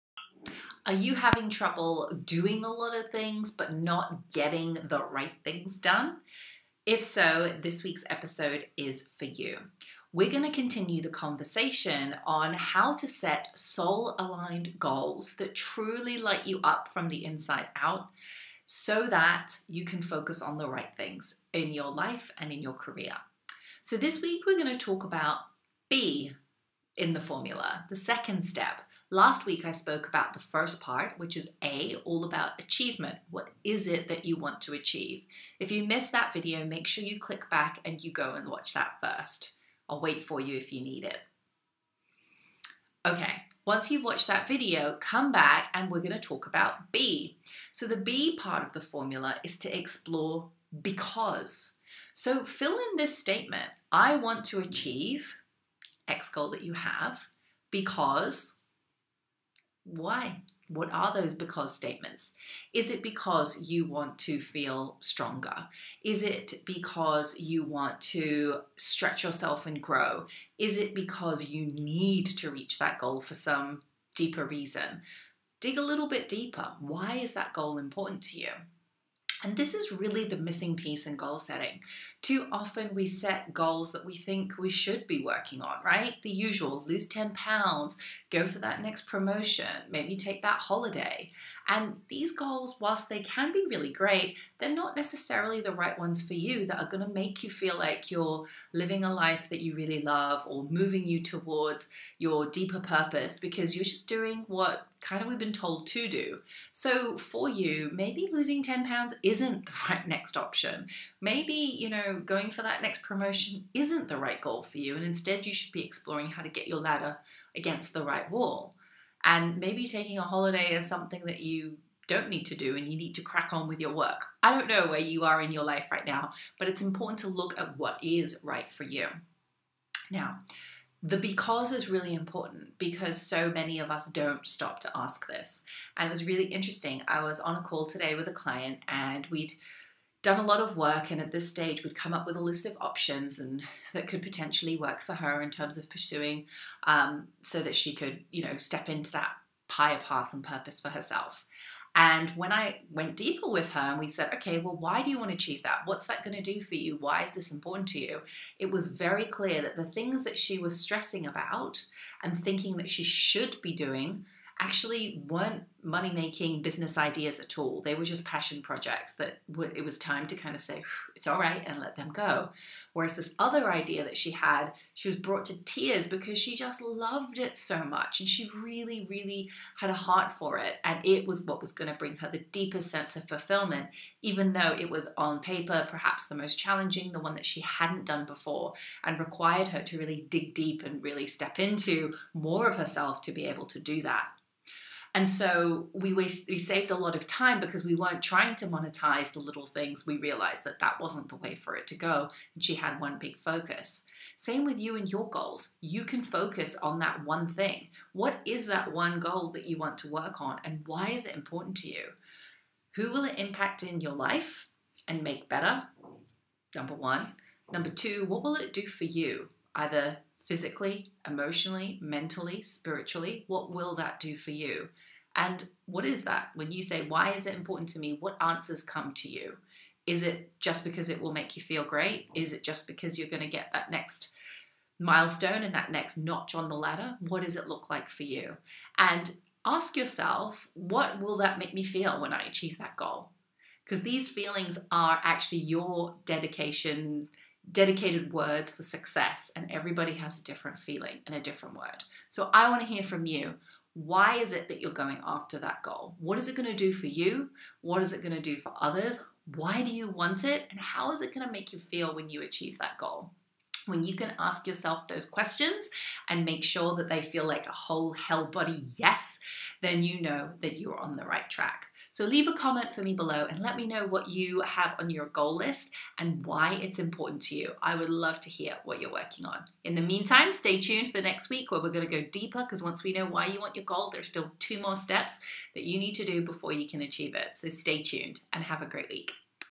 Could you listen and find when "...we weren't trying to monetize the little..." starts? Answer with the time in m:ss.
3:17.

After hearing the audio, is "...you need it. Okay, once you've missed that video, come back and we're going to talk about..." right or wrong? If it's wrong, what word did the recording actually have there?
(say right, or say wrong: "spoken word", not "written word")
wrong: "watched", not "missed".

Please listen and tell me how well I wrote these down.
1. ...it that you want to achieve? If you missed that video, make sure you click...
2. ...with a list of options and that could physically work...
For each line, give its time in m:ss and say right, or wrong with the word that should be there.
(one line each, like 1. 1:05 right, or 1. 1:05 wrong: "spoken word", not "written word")
1. 0:33 right
2. 2:22 wrong: "potentially", not "physically".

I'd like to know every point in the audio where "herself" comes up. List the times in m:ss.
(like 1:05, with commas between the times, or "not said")
2:30, 3:12.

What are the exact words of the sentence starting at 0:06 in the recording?
If so, this week's episode is for you.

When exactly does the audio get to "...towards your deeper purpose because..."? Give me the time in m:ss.
1:41.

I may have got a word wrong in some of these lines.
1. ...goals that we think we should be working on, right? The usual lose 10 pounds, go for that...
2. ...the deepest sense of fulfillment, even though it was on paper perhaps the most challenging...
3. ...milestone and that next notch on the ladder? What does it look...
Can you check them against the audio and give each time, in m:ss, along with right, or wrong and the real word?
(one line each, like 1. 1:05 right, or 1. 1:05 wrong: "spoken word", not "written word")
1. 1:23 right
2. 3:02 right
3. 3:54 right.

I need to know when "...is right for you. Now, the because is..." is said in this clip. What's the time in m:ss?
2:08.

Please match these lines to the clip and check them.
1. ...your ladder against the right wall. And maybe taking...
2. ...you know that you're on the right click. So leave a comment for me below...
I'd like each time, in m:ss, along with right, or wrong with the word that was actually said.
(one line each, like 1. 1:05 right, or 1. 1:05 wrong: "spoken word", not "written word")
1. 1:56 right
2. 4:30 wrong: "track", not "click".